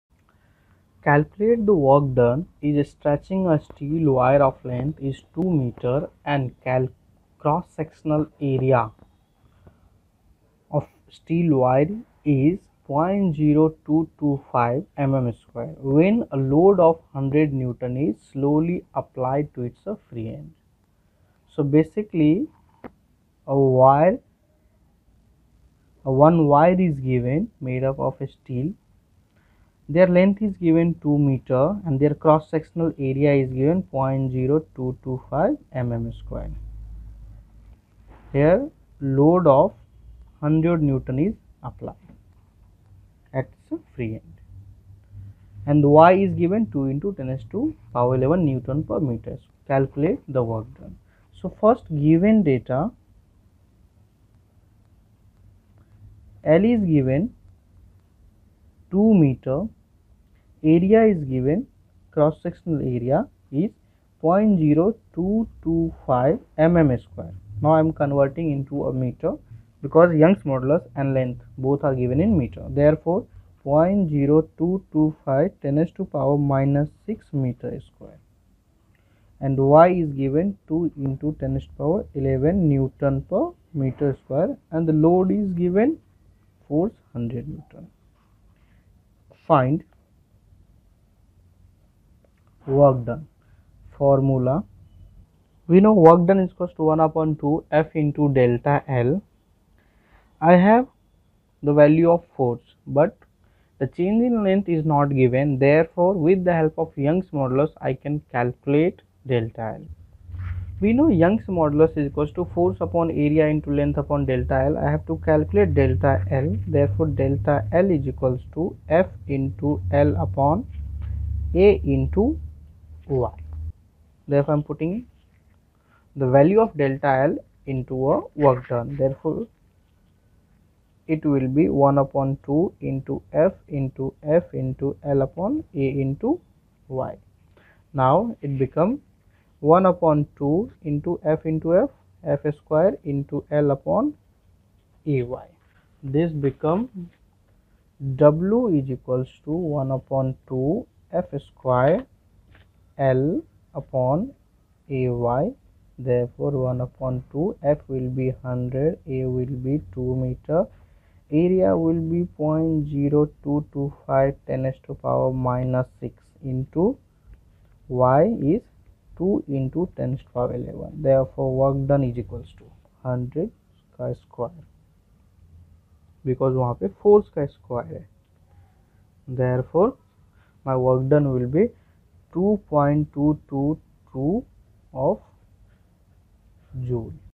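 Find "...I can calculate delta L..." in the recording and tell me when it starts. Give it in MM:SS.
01:47.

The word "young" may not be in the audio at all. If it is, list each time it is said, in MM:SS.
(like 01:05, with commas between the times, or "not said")
01:10, 01:46, 01:51.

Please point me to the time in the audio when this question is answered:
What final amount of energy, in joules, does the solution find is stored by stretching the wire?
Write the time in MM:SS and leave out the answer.
03:02.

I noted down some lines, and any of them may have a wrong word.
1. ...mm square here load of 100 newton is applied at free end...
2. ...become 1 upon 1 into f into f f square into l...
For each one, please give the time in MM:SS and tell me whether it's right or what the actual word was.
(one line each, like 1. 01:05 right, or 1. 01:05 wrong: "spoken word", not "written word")
1. 00:35 right
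2. 02:18 wrong: "2", not "1".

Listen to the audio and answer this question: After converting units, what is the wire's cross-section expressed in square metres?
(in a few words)
0.0225 × 10^-6 m².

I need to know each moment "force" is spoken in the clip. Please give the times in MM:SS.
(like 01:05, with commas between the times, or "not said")
01:26, 01:42, 01:52.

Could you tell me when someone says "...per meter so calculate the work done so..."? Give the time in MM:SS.
00:48.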